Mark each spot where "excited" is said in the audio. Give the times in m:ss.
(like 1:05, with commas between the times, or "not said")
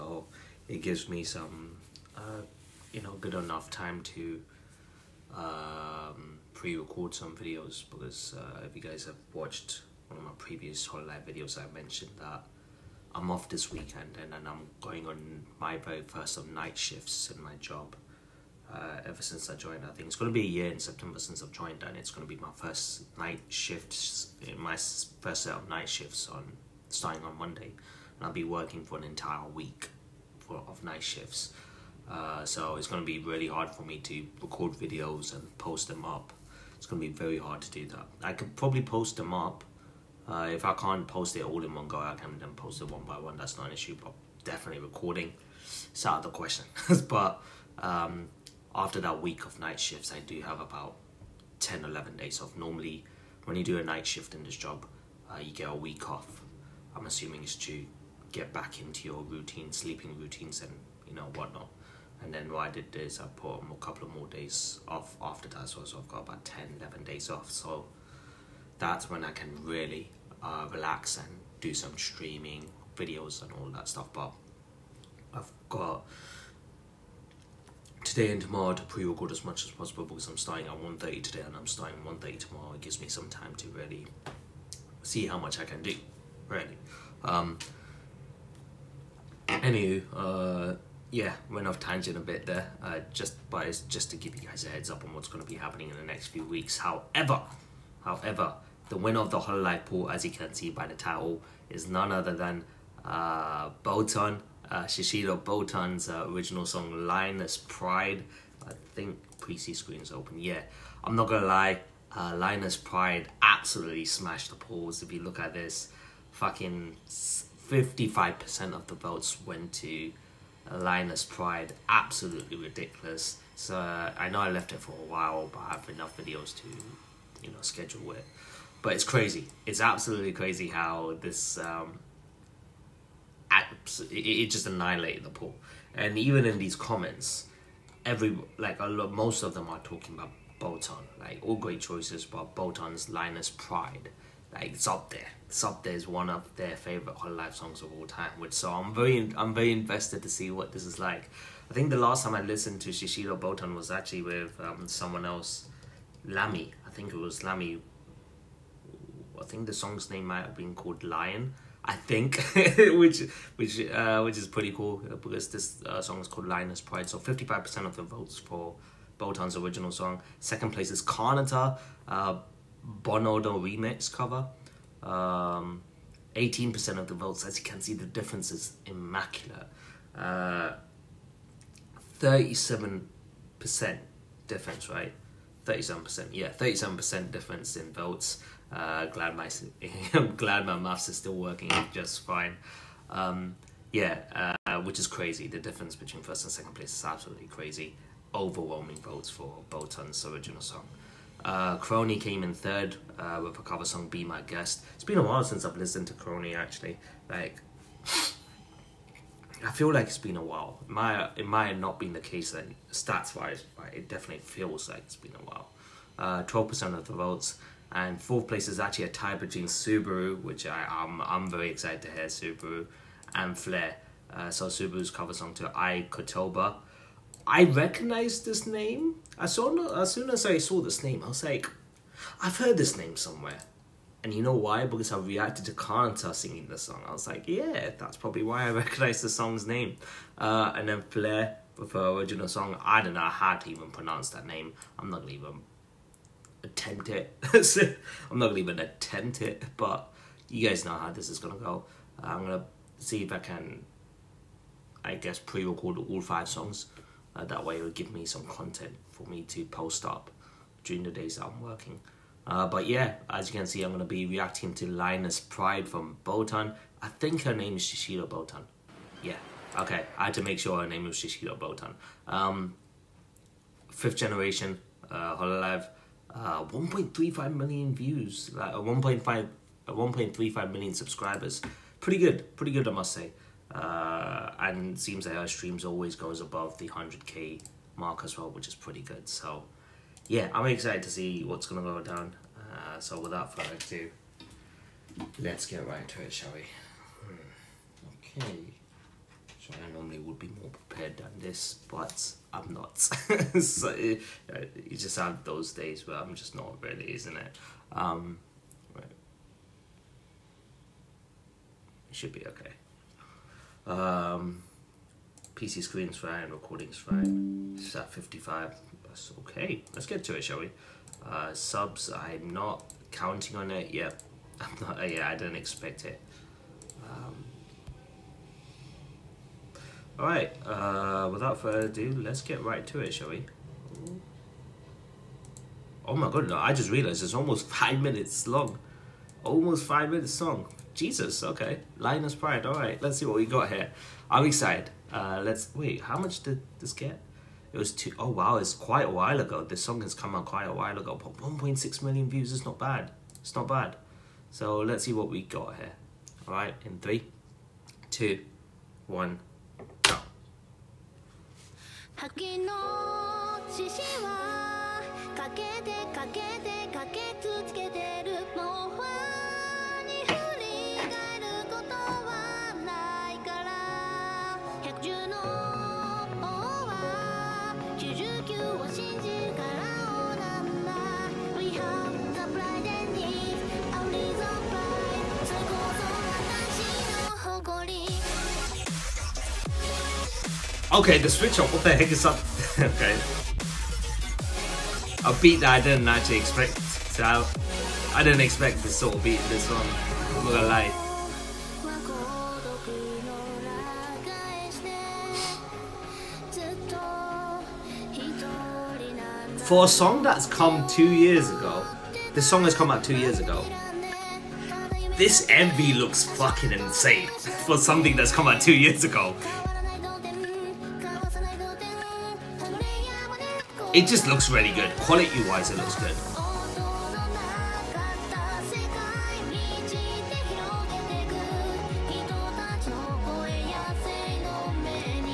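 3:41, 4:50, 5:44.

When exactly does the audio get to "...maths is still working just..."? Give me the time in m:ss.
3:10.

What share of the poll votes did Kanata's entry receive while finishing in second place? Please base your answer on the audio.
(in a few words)
18%.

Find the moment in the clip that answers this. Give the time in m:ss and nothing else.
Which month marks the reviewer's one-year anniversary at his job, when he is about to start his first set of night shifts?
0:20.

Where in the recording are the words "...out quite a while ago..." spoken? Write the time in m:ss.
5:50.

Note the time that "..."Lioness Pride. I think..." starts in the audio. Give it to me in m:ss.
1:47.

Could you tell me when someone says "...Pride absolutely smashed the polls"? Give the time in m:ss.
1:52.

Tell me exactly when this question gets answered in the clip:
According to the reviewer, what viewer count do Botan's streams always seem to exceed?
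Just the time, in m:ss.
4:46.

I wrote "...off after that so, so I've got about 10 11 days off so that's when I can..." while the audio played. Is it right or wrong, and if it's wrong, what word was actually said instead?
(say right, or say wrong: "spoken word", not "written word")
right.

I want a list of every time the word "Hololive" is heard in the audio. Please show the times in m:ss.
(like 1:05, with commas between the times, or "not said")
0:10, 1:39, 2:27, 4:35.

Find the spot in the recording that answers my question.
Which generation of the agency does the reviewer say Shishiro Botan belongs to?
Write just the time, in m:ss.
4:33.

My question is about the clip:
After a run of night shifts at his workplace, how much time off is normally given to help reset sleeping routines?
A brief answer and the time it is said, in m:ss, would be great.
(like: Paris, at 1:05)
a week, at 0:55.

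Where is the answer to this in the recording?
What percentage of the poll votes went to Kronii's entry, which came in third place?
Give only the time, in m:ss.
3:36.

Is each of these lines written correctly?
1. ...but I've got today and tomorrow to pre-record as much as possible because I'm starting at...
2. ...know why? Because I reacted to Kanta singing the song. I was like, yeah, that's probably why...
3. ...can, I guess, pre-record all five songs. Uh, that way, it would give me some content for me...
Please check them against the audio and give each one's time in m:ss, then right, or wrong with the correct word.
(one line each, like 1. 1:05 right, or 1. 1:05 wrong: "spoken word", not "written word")
1. 1:14 right
2. 3:54 right
3. 4:13 right.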